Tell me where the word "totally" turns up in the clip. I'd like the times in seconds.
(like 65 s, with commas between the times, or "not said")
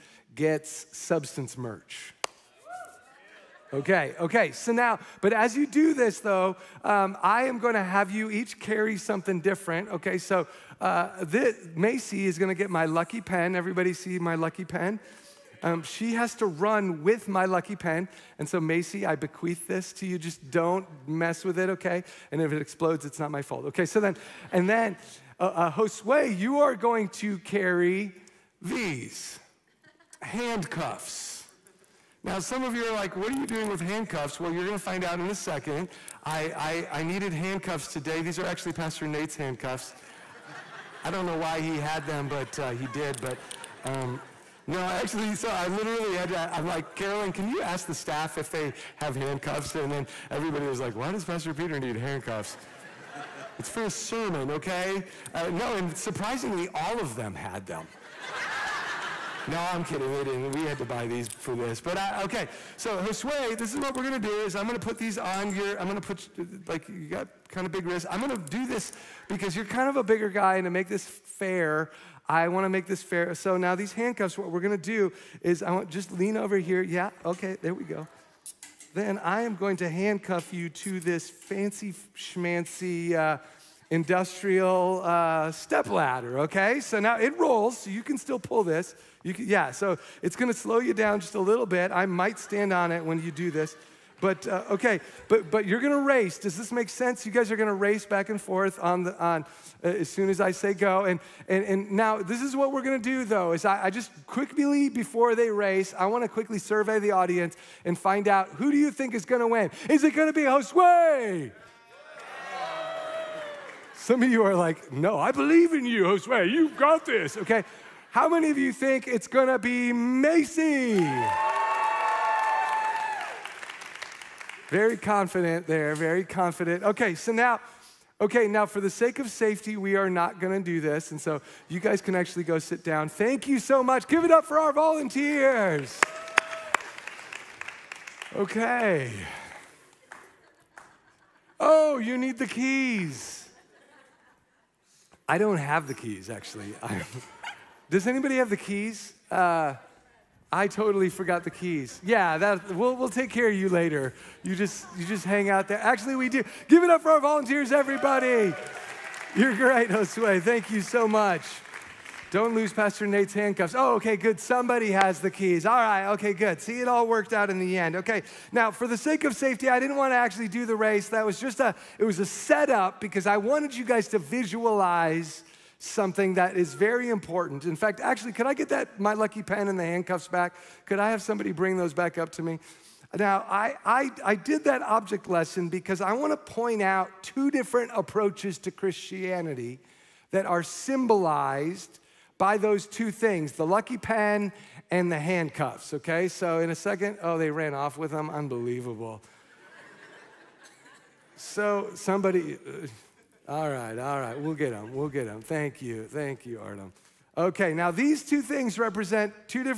150 s.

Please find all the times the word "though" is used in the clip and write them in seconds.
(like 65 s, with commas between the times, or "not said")
6 s, 103 s.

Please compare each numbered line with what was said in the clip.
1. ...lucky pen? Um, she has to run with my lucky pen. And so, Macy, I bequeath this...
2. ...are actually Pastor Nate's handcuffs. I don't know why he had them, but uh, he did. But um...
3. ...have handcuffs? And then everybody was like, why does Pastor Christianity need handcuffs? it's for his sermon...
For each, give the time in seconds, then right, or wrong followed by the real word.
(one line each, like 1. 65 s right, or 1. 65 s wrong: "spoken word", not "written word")
1. 14 s right
2. 38 s right
3. 48 s wrong: "Peter", not "Christianity".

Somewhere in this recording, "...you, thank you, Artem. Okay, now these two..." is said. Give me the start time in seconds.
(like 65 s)
205 s.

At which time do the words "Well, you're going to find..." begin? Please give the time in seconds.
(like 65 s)
34 s.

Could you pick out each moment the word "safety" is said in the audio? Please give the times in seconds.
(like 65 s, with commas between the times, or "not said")
129 s, 169 s.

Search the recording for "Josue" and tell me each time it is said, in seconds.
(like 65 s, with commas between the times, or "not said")
25 s, 62 s, 110 s, 116 s, 159 s.